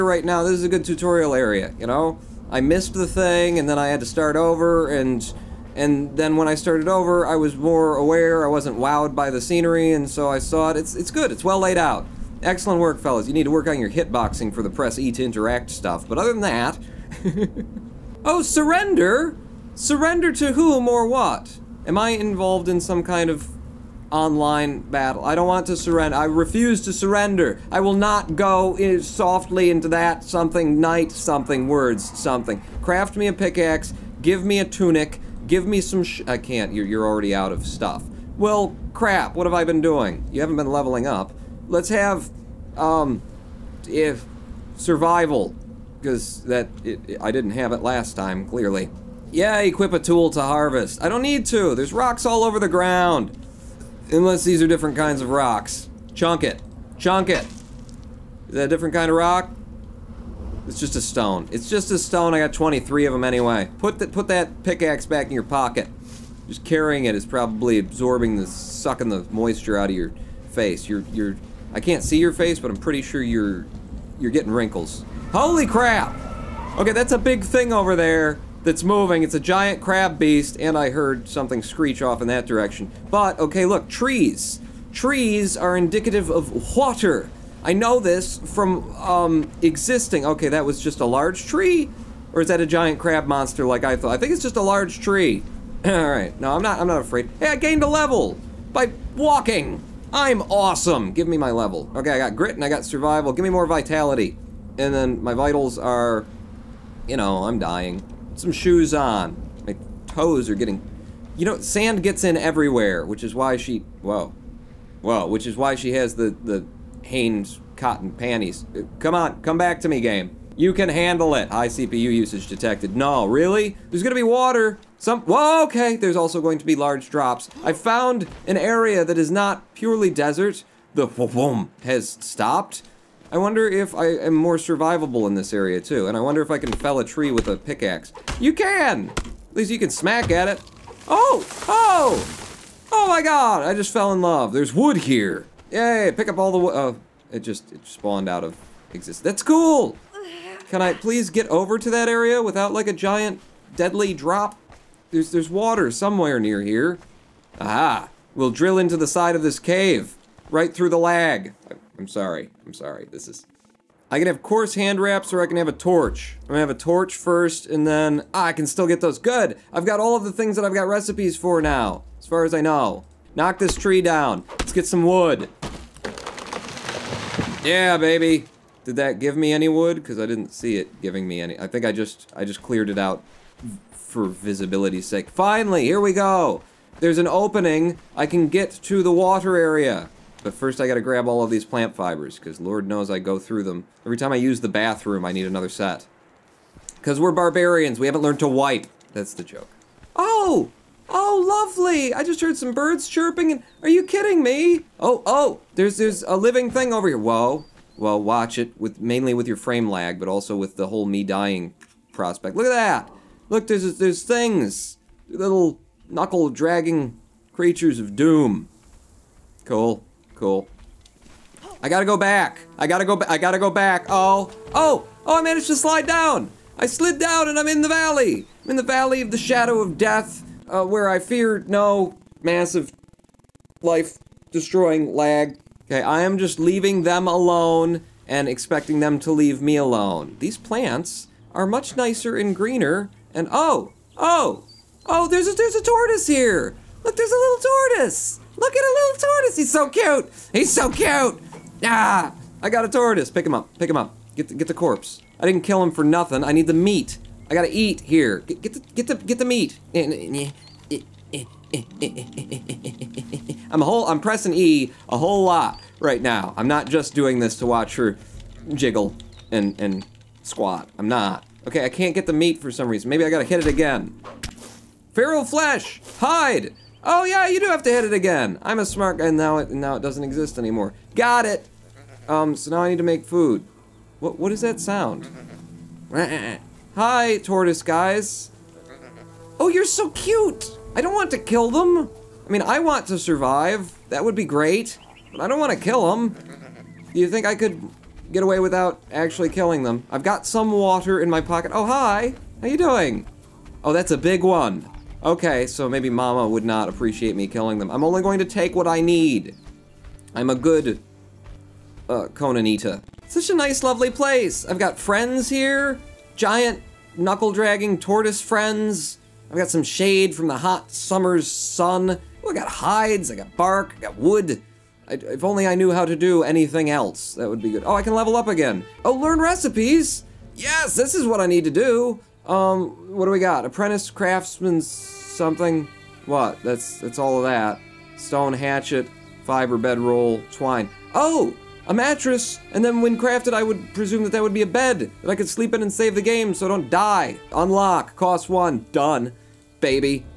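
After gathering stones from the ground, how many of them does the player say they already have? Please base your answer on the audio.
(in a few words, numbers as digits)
23.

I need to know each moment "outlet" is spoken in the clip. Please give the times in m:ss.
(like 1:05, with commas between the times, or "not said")
not said.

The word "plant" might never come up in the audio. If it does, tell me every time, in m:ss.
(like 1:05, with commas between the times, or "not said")
3:11, 4:00.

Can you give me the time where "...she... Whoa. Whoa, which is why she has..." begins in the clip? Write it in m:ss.
1:53.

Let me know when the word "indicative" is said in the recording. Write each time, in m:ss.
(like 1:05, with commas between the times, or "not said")
1:25.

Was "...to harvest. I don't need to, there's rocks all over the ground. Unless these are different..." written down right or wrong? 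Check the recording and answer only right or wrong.
right.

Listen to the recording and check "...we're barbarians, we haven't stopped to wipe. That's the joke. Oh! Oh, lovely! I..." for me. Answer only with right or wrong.
wrong.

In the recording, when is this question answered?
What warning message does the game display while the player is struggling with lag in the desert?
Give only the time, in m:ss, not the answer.
2:01.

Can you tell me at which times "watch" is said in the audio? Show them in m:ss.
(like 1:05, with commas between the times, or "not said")
3:28, 4:27.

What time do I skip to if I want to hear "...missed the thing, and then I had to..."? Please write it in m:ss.
0:02.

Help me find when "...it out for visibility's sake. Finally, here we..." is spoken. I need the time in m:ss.
3:02.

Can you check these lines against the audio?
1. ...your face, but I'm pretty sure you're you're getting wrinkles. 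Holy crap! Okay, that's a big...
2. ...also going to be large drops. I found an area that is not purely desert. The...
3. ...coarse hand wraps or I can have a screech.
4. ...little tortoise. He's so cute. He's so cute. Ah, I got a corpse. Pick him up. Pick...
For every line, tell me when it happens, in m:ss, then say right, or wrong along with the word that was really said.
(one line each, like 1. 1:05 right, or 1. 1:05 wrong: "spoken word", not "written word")
1. 1:12 right
2. 2:06 right
3. 2:44 wrong: "torch", not "screech"
4. 4:08 wrong: "tortoise", not "corpse".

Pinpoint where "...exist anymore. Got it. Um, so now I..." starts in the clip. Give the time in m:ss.
4:40.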